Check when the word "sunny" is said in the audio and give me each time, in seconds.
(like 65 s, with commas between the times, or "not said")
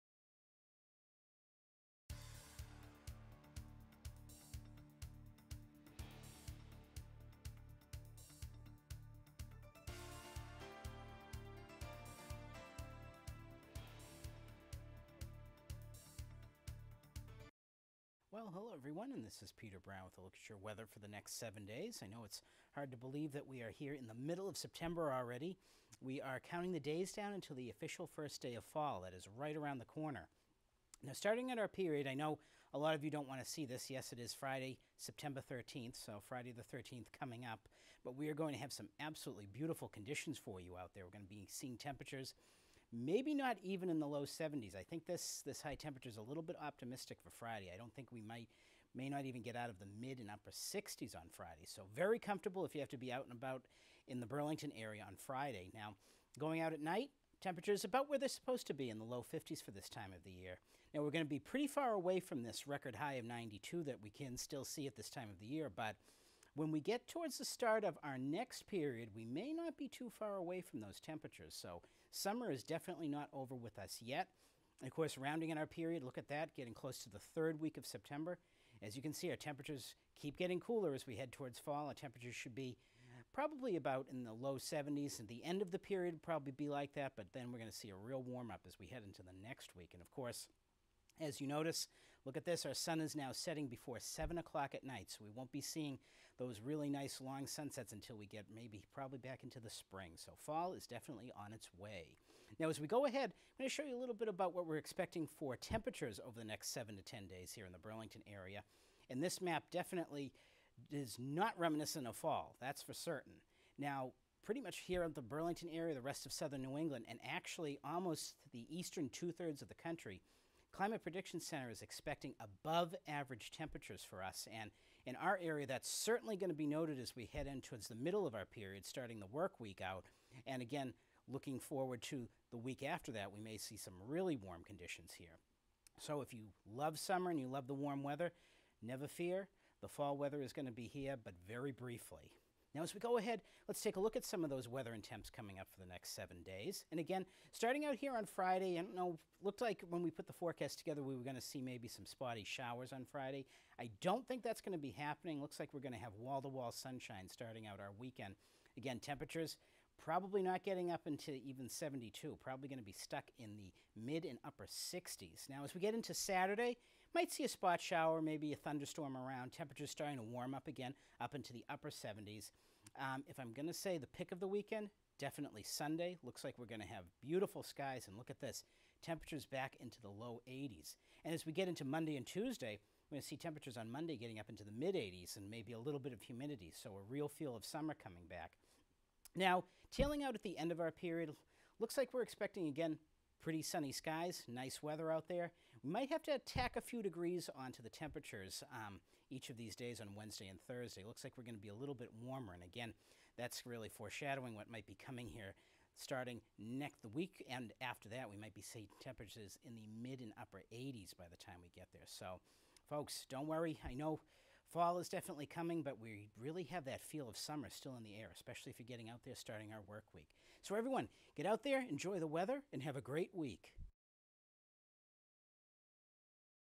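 193 s.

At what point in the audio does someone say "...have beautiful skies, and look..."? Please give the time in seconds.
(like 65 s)
176 s.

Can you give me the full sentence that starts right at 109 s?
And this map definitely is not reminiscent of fall, that's for certain.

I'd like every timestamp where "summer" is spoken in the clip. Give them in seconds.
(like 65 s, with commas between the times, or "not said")
72 s, 136 s, 187 s, 217 s.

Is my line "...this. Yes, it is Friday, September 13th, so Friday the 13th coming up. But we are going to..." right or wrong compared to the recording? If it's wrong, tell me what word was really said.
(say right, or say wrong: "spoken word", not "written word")
right.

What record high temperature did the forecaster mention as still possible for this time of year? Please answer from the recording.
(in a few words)
92.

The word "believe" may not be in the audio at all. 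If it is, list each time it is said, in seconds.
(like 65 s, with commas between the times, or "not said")
22 s.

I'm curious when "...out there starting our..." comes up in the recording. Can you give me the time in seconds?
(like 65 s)
219 s.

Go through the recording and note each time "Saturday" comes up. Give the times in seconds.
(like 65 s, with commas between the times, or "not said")
166 s.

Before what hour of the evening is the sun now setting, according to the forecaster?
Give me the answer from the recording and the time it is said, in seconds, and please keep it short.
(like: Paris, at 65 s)
7 o'clock, at 94 s.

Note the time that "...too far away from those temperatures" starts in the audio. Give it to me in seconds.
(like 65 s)
69 s.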